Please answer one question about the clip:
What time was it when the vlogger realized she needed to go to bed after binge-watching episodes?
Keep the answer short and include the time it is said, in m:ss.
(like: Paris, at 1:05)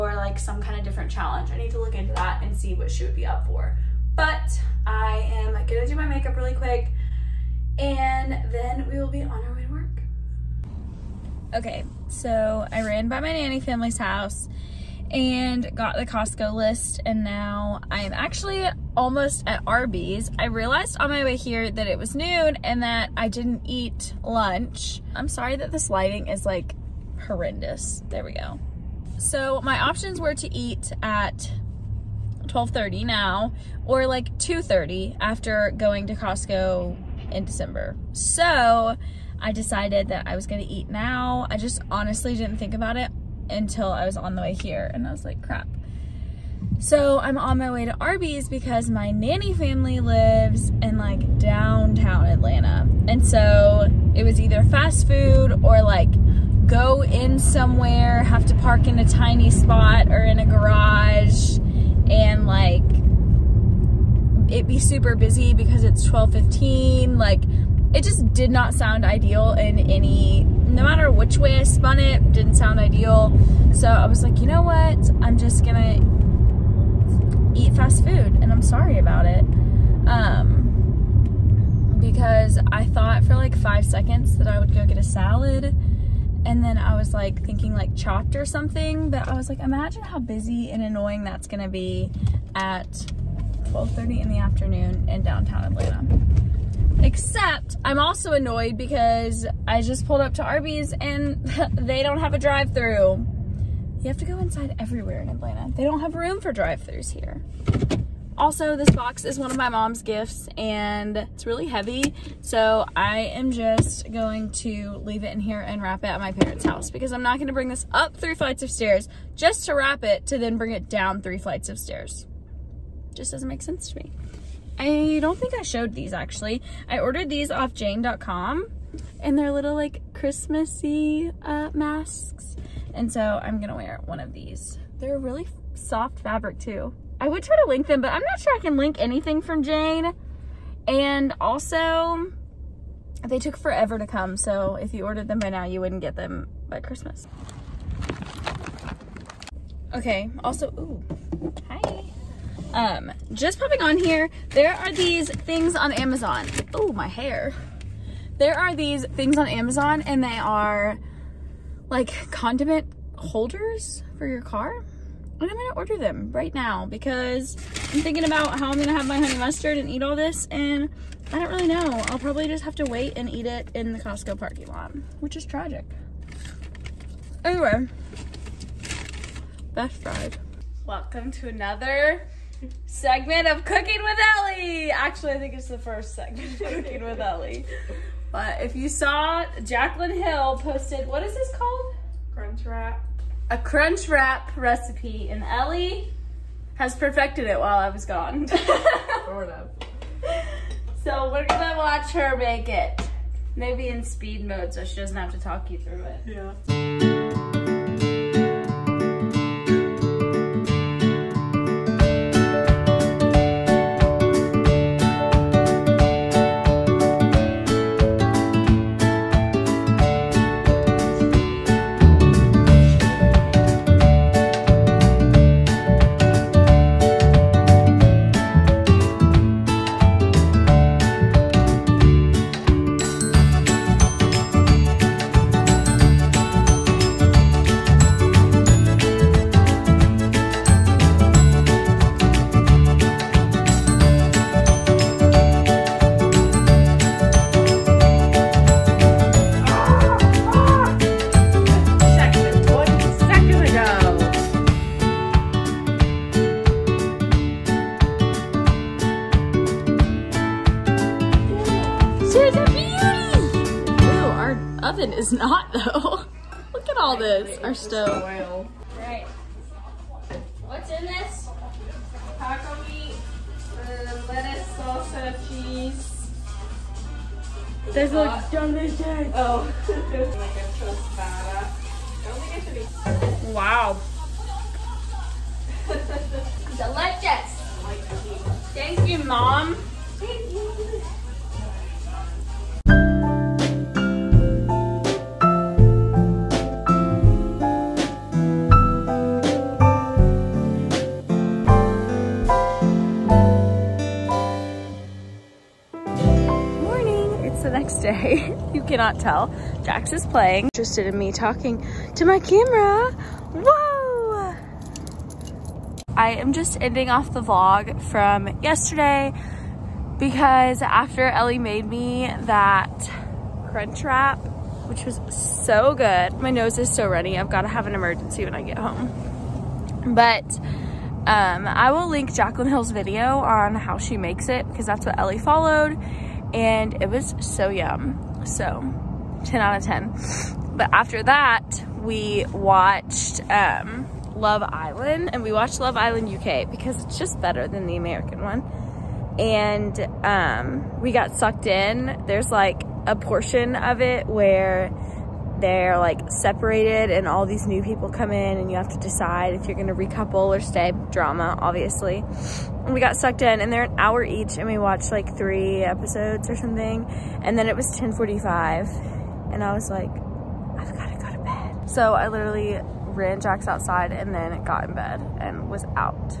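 10:45, at 6:07.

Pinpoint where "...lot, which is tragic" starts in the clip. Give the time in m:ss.
2:54.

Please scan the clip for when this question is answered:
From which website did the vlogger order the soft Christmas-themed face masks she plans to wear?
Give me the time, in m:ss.
2:07.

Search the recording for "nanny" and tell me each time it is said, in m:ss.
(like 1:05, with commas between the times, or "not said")
0:13, 0:49.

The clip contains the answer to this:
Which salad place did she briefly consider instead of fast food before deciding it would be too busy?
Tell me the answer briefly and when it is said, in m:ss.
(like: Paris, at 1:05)
Chopped, at 1:27.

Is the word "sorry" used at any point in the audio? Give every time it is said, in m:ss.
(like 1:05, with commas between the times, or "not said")
0:25, 1:18.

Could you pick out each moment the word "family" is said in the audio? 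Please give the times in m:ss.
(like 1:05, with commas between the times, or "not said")
0:13, 0:49.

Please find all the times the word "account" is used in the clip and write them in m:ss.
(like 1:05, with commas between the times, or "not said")
not said.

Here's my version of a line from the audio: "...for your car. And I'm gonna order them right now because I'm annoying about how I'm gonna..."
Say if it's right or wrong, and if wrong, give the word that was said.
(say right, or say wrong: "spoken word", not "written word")
wrong: "thinking", not "annoying".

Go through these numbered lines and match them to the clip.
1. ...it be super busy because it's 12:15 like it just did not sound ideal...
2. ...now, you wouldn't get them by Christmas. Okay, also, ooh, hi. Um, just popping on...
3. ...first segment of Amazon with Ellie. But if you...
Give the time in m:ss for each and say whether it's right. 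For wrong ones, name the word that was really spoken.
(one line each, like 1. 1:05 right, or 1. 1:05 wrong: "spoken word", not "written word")
1. 1:04 right
2. 2:25 right
3. 3:05 wrong: "Cooking", not "Amazon".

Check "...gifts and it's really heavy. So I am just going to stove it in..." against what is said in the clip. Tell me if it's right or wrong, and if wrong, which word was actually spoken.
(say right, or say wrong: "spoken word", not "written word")
wrong: "leave", not "stove".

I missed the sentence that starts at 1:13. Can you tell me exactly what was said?
So I was like, you know what?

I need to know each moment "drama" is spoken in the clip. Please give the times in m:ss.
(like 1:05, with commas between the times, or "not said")
6:01.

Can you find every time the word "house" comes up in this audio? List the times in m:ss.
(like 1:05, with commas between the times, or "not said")
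0:13, 1:56.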